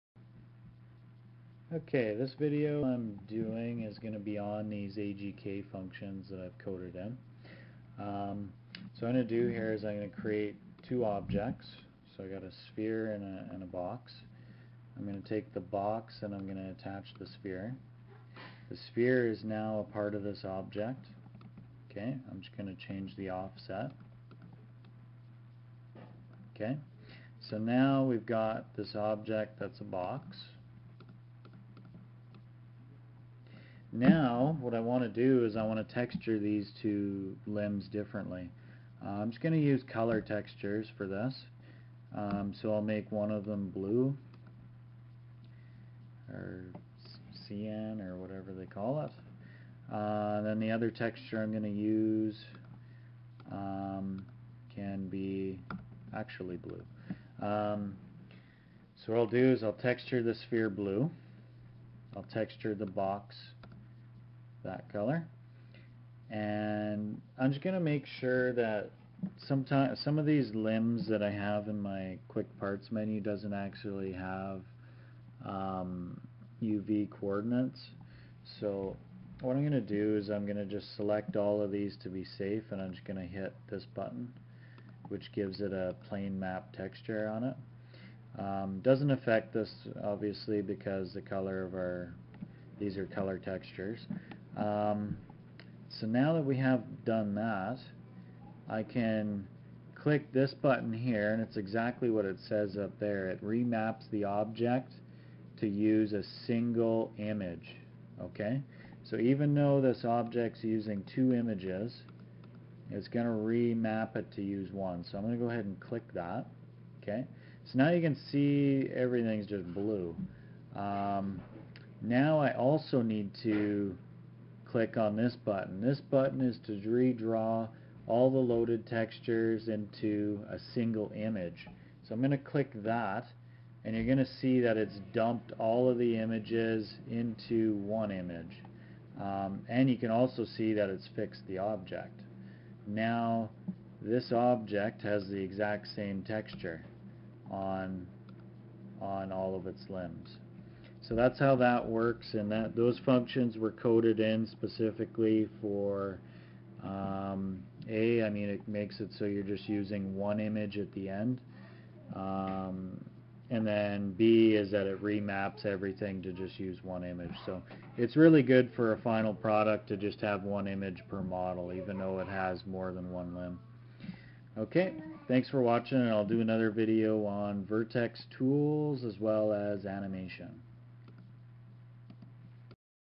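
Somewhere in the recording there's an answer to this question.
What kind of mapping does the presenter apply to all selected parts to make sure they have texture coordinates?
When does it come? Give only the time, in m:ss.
1:26.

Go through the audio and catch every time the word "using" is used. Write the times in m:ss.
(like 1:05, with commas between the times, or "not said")
1:50, 2:39.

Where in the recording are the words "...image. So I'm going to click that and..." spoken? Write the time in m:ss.
2:11.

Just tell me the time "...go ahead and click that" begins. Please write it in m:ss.
1:55.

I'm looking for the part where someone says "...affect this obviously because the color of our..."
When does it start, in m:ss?
1:29.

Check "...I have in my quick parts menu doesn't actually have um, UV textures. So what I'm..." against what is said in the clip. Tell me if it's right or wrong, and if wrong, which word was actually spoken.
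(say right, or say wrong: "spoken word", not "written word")
wrong: "coordinates", not "textures".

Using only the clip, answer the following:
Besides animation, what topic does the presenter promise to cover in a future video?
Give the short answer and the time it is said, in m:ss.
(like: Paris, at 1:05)
vertex tools, at 2:57.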